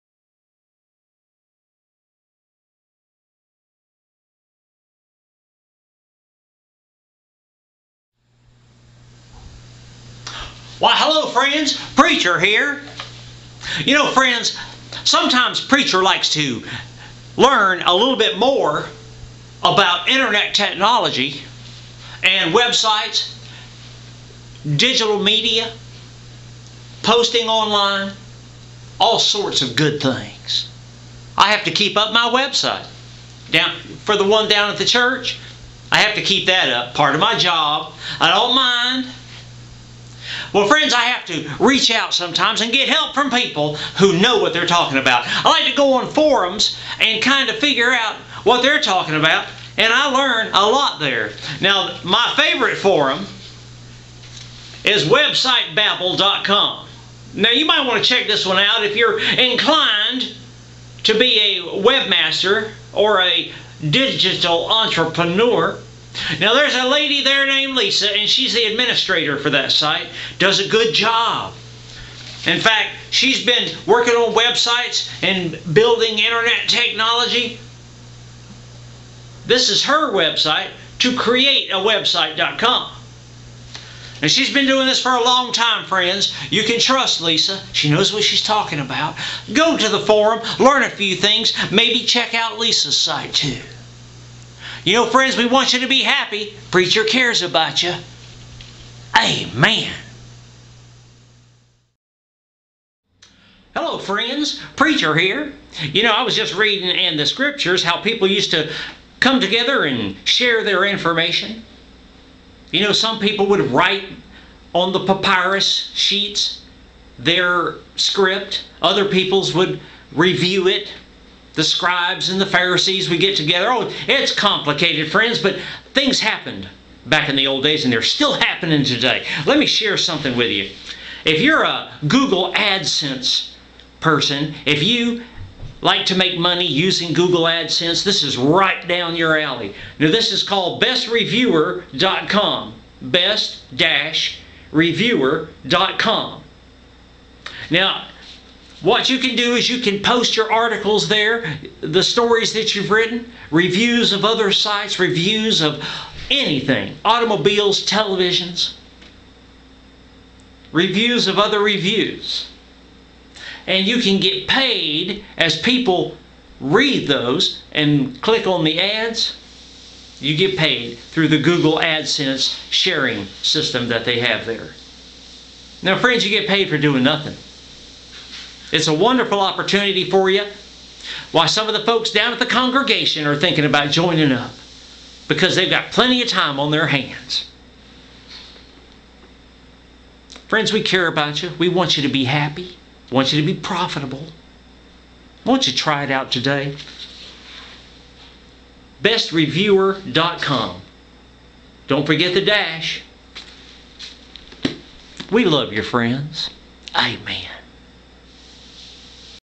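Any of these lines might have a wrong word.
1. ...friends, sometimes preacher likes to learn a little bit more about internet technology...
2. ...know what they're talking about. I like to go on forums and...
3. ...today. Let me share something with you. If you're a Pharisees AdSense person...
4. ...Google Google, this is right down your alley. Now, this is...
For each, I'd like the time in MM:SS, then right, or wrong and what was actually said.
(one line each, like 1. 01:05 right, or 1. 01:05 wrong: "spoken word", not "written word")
1. 00:14 right
2. 00:44 right
3. 02:08 wrong: "Google", not "Pharisees"
4. 02:17 wrong: "AdSense", not "Google".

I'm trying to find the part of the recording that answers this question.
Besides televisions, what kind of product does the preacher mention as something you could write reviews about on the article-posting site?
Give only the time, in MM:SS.
02:37.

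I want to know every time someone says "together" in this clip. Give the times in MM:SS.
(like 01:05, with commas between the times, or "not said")
01:49, 02:03.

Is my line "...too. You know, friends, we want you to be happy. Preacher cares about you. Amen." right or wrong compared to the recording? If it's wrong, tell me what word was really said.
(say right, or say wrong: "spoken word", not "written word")
right.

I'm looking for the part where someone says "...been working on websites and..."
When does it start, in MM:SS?
01:13.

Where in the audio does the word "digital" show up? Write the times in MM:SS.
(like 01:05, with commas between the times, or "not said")
00:24, 01:03.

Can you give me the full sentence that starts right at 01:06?
Now there's a lady there named Lisa, and she's the administrator for that site.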